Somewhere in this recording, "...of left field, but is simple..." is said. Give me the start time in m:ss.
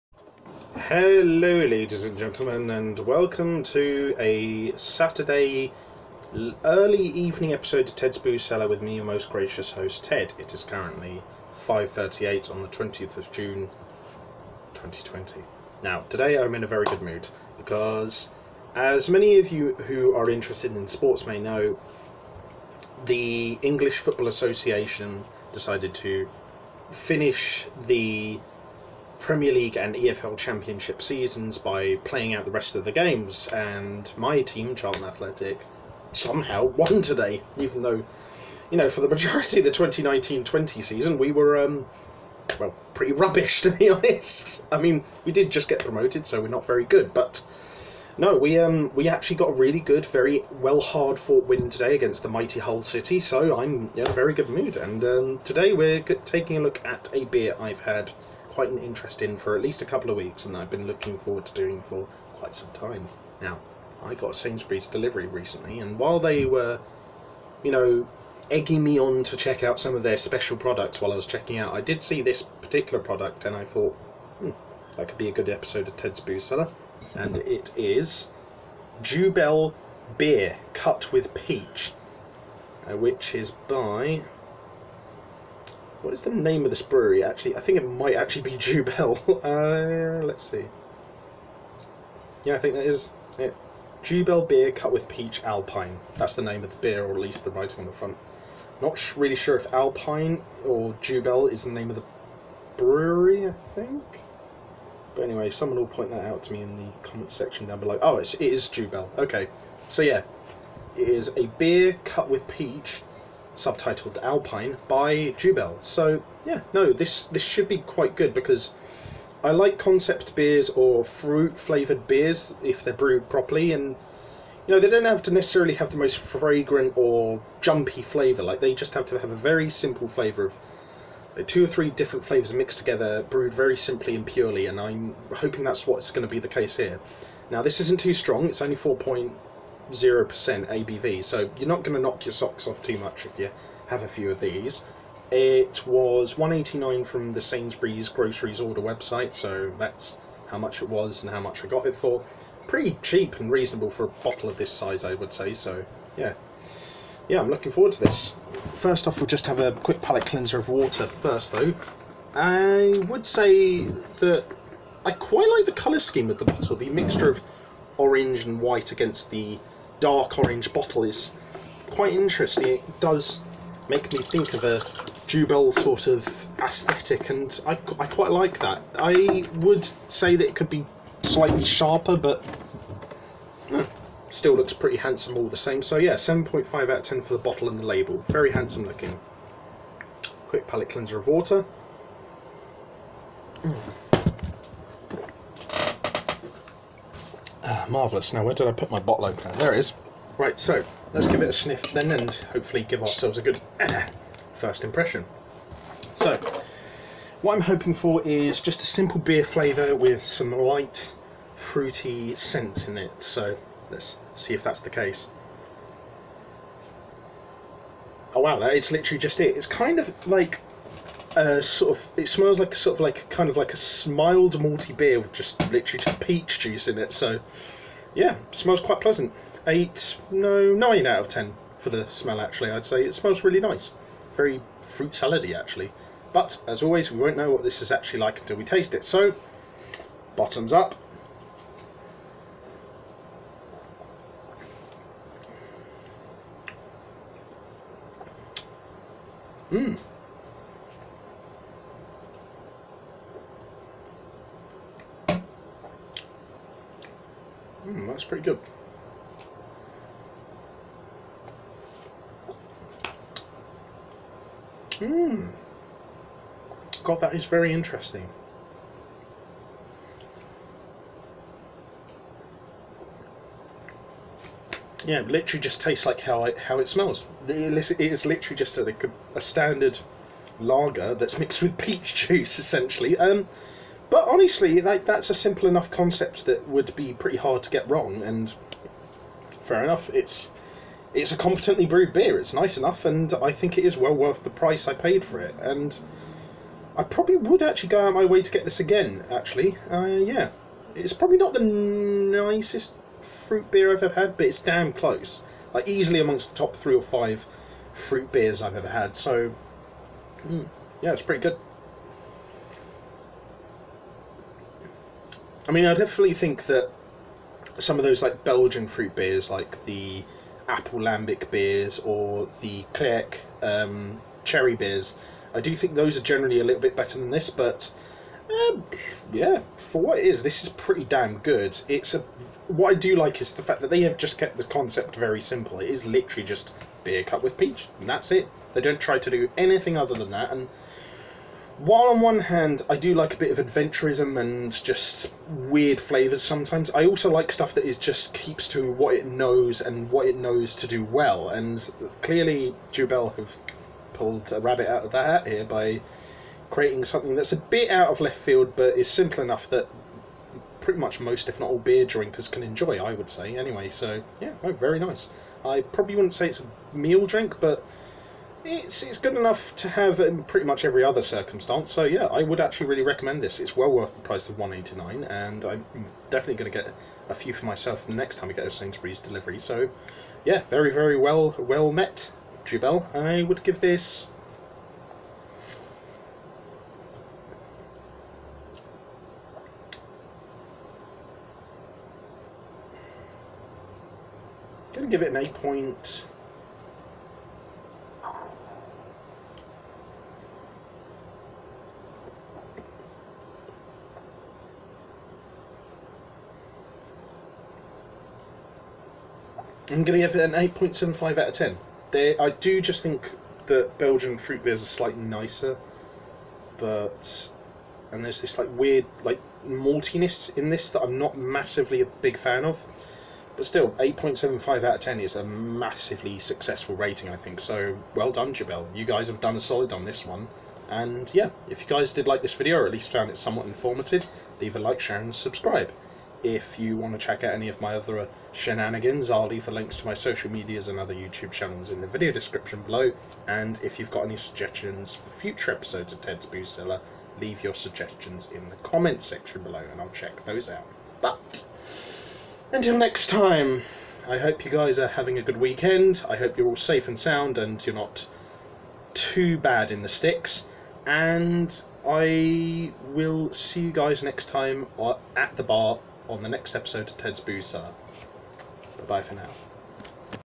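5:58.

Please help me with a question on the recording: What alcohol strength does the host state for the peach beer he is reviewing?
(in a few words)
4.0%.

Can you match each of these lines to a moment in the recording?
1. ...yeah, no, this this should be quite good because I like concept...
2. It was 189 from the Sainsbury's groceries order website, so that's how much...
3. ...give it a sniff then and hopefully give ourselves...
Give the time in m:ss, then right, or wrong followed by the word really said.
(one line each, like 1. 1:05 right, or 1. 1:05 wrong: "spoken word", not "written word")
1. 1:56 right
2. 2:25 right
3. 3:21 right.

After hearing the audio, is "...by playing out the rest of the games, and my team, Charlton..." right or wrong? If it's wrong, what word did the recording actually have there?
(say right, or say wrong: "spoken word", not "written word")
right.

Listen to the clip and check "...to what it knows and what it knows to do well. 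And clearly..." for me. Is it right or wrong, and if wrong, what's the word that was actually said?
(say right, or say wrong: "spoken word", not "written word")
right.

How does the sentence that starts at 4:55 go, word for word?
And I probably would actually go out my way to get this again.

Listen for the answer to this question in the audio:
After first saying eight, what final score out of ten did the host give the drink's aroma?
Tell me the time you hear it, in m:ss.
3:50.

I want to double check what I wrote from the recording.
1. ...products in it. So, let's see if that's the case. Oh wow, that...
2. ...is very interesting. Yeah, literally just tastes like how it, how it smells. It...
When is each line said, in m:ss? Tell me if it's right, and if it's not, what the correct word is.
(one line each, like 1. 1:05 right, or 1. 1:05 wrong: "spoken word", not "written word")
1. 3:32 wrong: "scents", not "products"
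2. 4:27 right.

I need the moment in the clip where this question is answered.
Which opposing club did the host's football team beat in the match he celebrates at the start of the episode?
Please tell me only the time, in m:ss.
0:52.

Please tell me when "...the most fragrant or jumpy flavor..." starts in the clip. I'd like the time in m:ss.
2:05.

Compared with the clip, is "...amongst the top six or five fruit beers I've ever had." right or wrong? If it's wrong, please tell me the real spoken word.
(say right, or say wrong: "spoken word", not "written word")
wrong: "three", not "six".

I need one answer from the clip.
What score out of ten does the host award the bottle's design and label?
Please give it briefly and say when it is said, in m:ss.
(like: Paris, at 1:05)
7.5, at 3:06.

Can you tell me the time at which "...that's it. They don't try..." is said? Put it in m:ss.
5:38.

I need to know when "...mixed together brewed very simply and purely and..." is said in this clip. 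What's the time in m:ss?
2:12.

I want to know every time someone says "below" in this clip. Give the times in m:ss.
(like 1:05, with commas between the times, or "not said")
1:47, 7:22, 7:29.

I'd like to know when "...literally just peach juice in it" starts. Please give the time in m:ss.
3:45.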